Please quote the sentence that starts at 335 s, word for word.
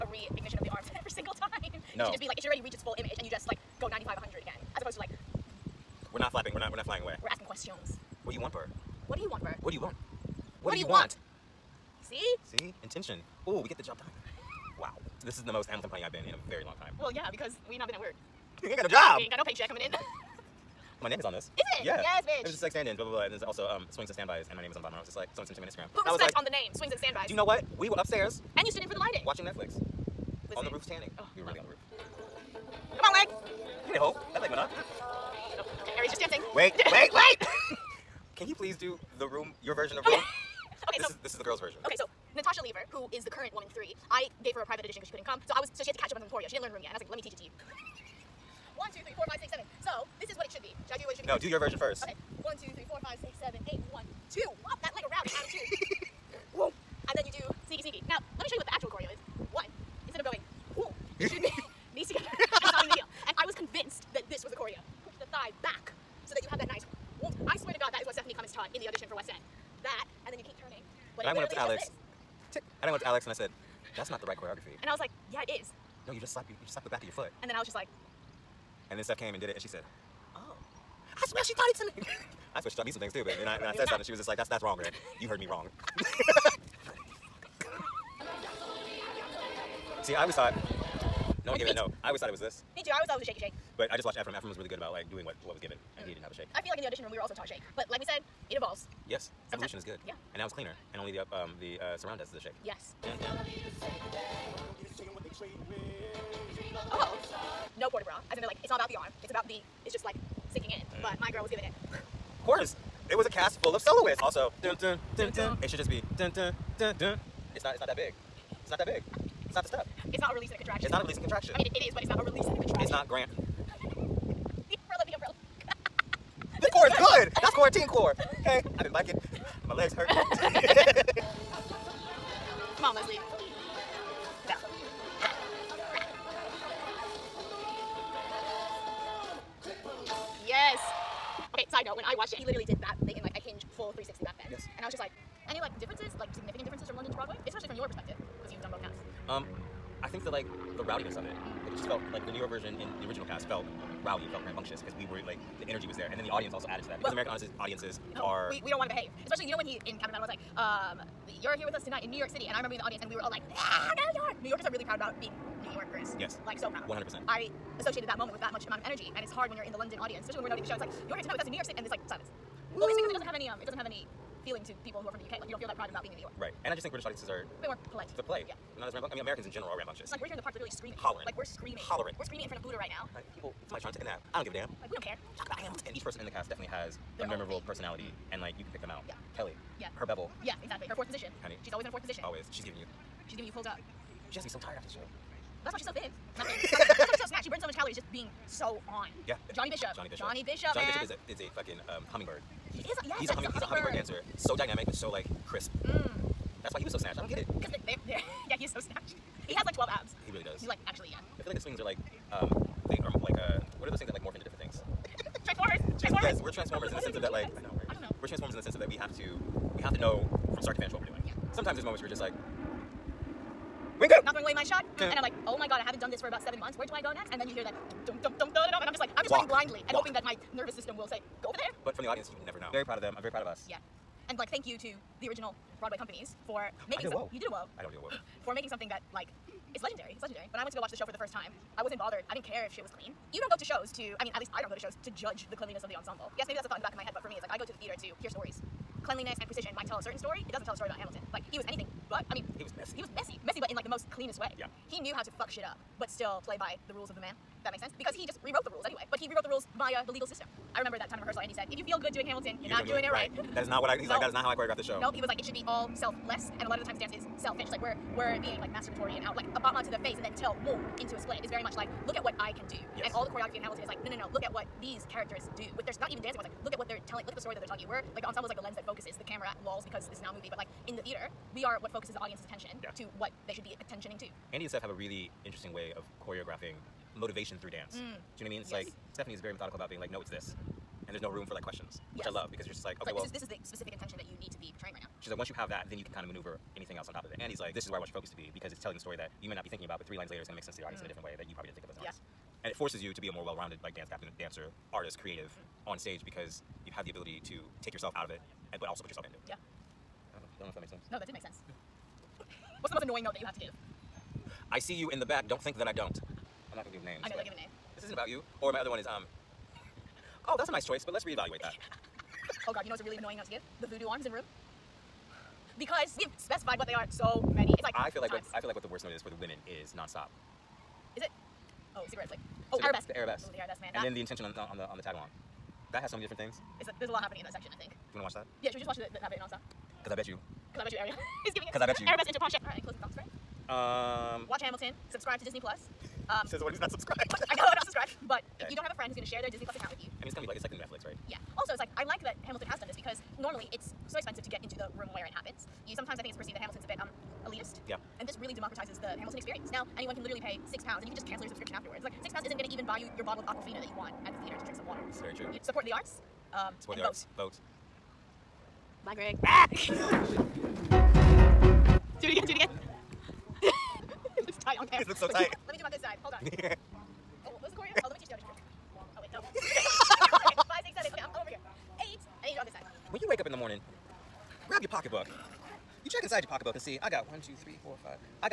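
That has so many different things.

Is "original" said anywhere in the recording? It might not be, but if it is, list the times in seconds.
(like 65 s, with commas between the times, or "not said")
153 s, 235 s.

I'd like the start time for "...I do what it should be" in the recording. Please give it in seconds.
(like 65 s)
50 s.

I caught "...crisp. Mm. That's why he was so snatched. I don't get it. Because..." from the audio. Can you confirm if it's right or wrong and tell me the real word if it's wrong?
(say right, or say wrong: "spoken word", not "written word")
right.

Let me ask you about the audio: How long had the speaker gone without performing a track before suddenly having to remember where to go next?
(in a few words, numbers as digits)
7 months.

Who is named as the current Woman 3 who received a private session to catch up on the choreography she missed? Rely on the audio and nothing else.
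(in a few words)
Natasha Lever.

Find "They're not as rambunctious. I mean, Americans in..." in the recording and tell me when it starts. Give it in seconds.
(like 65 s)
178 s.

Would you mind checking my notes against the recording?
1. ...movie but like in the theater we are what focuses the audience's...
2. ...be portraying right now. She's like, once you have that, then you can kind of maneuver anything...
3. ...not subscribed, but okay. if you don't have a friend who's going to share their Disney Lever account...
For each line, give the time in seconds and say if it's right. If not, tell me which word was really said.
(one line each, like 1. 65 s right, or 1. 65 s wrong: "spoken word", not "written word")
1. 280 s right
2. 294 s right
3. 347 s wrong: "Plus", not "Lever".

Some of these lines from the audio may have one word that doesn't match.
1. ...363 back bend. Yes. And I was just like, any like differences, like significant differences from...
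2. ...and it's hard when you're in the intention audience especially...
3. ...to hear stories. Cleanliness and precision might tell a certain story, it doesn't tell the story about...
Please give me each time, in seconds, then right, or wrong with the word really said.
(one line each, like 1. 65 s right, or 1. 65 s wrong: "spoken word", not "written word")
1. 143 s wrong: "360", not "363"
2. 169 s wrong: "london", not "intention"
3. 248 s right.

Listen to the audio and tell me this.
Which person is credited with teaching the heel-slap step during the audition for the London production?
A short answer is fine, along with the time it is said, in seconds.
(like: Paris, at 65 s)
Stephanie Klemons, at 68 s.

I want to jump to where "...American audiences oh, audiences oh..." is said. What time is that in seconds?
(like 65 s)
157 s.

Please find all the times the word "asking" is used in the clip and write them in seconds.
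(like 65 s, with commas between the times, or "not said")
7 s.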